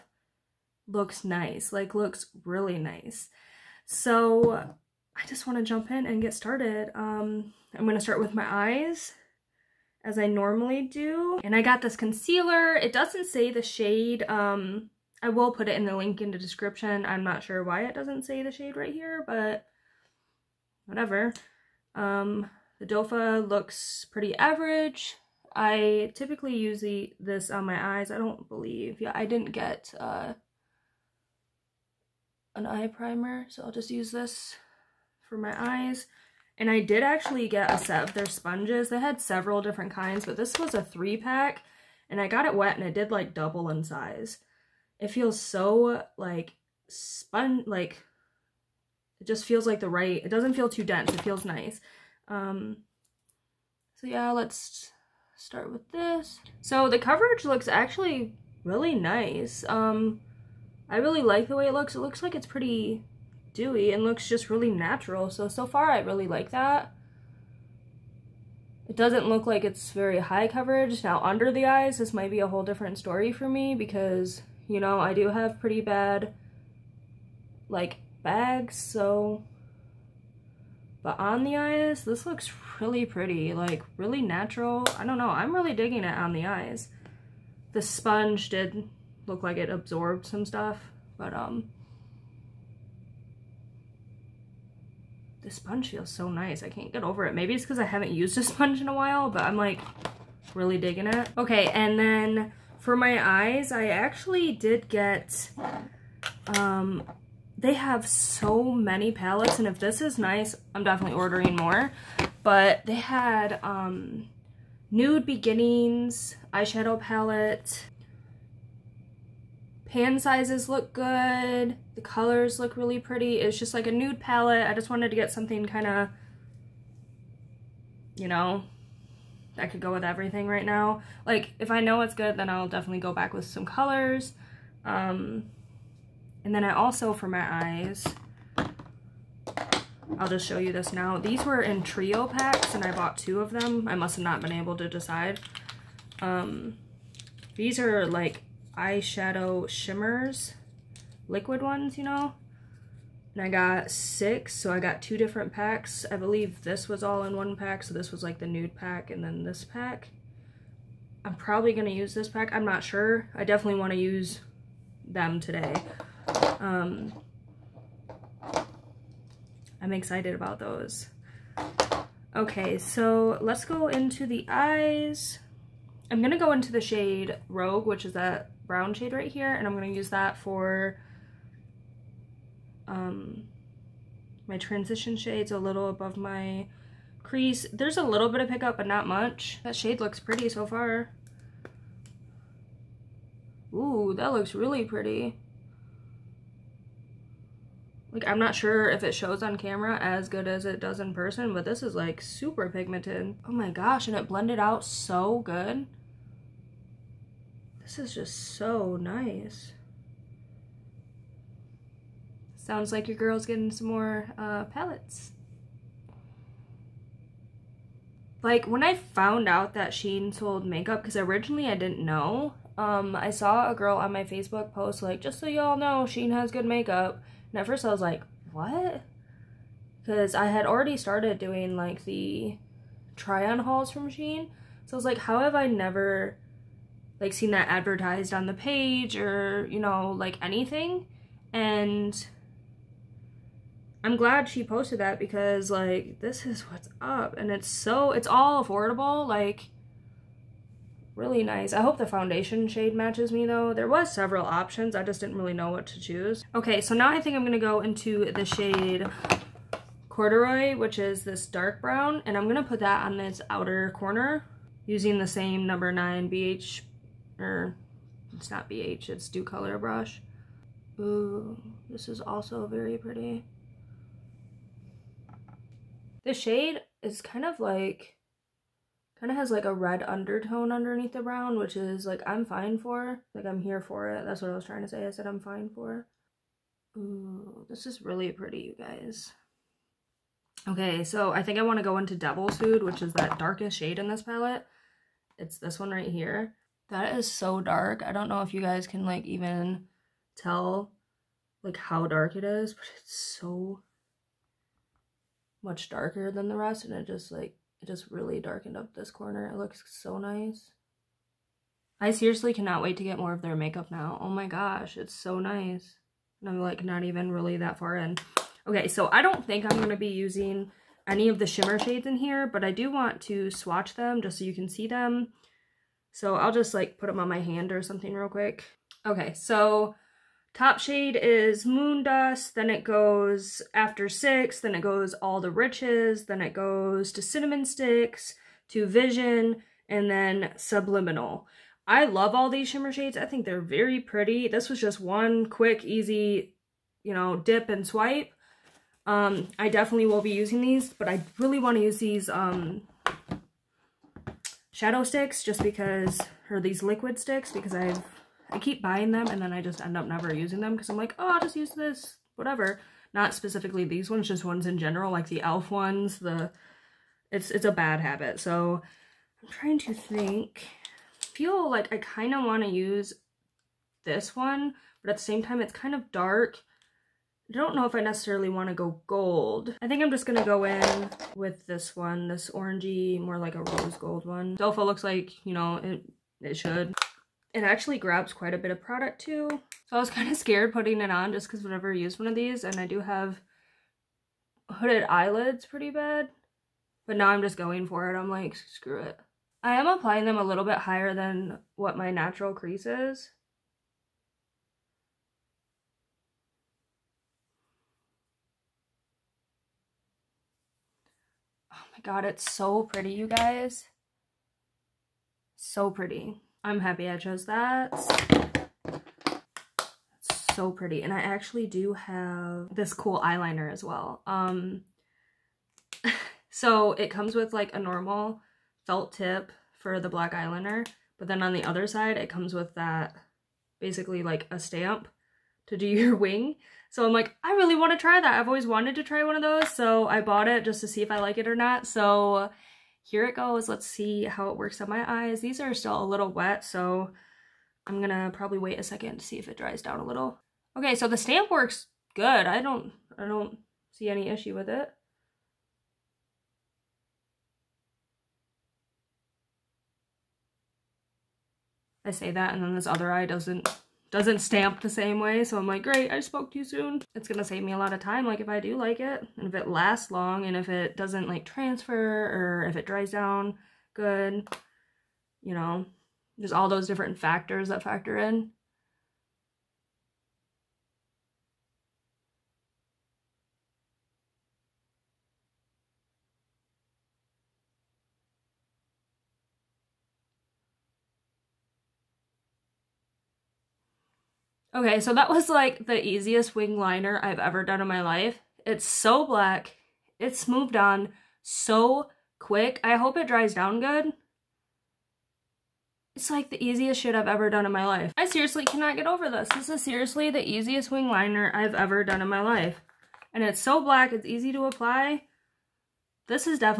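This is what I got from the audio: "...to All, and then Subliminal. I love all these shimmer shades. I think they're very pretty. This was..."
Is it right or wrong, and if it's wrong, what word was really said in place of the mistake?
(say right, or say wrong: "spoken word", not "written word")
wrong: "Vision", not "All".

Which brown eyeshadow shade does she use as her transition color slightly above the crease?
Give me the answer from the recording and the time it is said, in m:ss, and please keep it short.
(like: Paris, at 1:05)
Rogue, at 2:57.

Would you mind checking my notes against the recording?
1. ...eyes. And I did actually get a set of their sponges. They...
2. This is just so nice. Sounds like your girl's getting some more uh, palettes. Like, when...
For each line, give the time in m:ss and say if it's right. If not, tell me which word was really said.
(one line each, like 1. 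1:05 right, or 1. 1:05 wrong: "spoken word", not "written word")
1. 0:35 right
2. 3:27 right.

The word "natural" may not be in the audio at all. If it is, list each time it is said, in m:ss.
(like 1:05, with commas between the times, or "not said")
1:04, 1:24, 6:42.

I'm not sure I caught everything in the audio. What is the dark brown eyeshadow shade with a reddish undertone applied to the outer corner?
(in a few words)
Corduroy.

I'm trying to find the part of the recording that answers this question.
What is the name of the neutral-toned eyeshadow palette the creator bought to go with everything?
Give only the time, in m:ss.
1:54.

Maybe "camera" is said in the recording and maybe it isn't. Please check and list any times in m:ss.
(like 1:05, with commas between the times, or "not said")
3:19.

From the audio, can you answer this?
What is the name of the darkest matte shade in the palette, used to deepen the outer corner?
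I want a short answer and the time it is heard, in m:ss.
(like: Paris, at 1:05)
Devil's Food, at 4:52.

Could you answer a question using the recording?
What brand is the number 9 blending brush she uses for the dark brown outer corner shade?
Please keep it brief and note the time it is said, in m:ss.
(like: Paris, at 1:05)
Docolor, at 4:29.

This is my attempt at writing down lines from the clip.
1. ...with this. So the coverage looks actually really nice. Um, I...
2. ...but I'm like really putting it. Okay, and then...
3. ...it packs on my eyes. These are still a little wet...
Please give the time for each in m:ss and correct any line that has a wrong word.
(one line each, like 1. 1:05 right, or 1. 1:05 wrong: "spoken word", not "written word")
1. 0:55 right
2. 1:39 wrong: "digging", not "putting"
3. 7:24 wrong: "works", not "packs".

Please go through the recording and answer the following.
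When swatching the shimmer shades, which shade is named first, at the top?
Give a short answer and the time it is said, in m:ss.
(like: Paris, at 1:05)
Moondust, at 5:31.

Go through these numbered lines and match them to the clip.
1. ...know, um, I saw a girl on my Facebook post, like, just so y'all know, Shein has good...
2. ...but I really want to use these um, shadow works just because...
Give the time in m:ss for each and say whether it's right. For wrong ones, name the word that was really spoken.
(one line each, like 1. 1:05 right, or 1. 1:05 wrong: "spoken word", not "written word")
1. 3:42 right
2. 5:50 wrong: "sticks", not "works".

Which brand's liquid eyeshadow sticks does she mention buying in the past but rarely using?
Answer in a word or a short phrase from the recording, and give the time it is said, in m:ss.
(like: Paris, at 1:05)
e.l.f., at 6:05.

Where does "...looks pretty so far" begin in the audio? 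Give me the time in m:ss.
3:09.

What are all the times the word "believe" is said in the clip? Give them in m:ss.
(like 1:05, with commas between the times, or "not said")
0:28, 2:36.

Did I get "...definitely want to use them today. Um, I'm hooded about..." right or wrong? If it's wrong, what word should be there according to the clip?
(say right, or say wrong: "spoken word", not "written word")
wrong: "excited", not "hooded".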